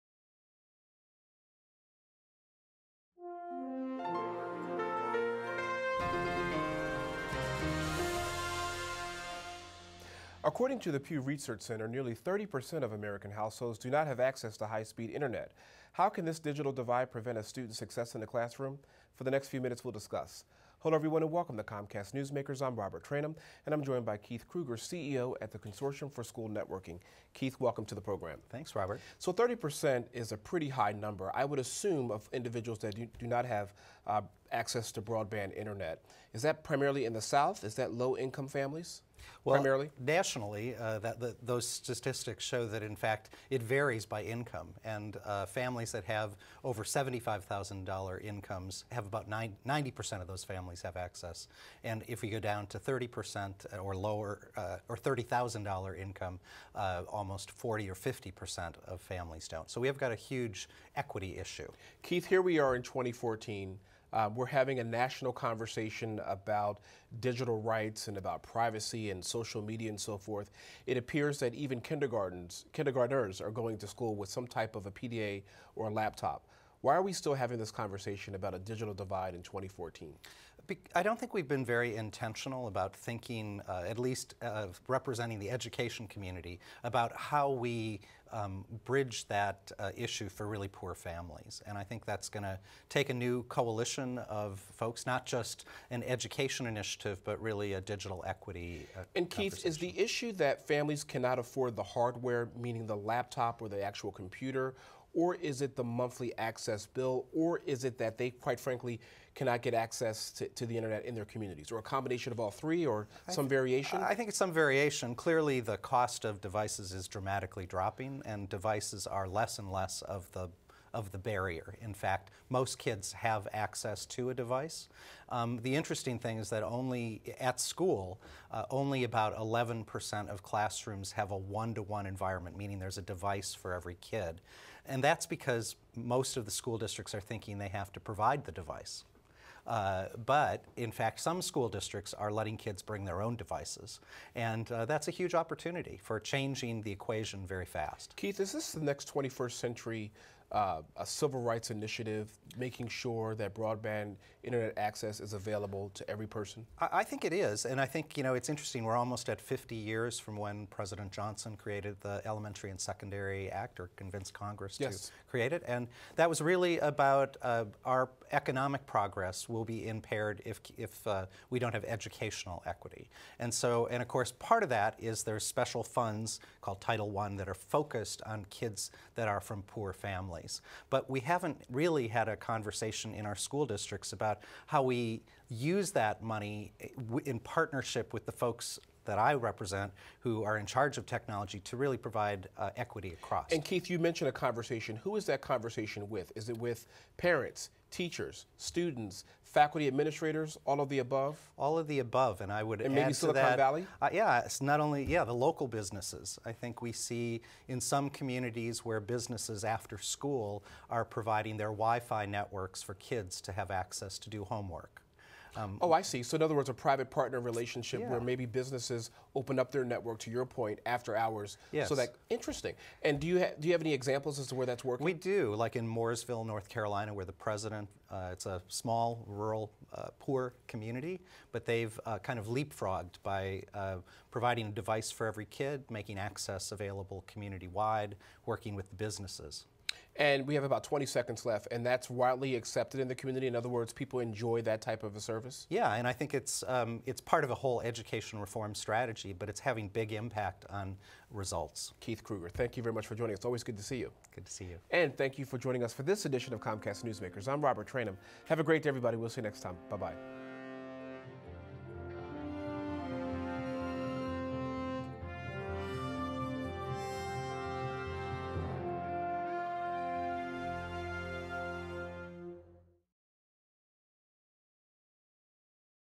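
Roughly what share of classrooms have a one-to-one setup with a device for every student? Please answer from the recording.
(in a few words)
11%.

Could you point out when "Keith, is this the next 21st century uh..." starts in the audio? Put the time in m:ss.
2:28.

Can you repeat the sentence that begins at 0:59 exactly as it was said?
So we have got a huge equity issue.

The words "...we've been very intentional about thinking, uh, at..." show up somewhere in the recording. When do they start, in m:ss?
1:21.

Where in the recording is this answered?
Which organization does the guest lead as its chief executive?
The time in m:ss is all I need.
0:25.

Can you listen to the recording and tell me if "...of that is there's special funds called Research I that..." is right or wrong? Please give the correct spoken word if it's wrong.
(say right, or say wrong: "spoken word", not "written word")
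wrong: "Title", not "Research".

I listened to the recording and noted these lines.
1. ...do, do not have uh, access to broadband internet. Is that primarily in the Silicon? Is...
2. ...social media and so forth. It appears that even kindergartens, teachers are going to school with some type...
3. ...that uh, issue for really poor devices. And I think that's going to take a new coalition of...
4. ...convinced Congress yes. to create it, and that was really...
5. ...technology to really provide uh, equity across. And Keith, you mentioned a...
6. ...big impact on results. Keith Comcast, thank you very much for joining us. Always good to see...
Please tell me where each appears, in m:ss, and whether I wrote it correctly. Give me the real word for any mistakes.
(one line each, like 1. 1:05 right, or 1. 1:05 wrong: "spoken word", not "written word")
1. 0:32 wrong: "South", not "Silicon"
2. 1:09 wrong: "kindergartners", not "teachers"
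3. 1:29 wrong: "families", not "devices"
4. 2:43 right
5. 3:11 right
6. 4:09 wrong: "Krueger", not "Comcast".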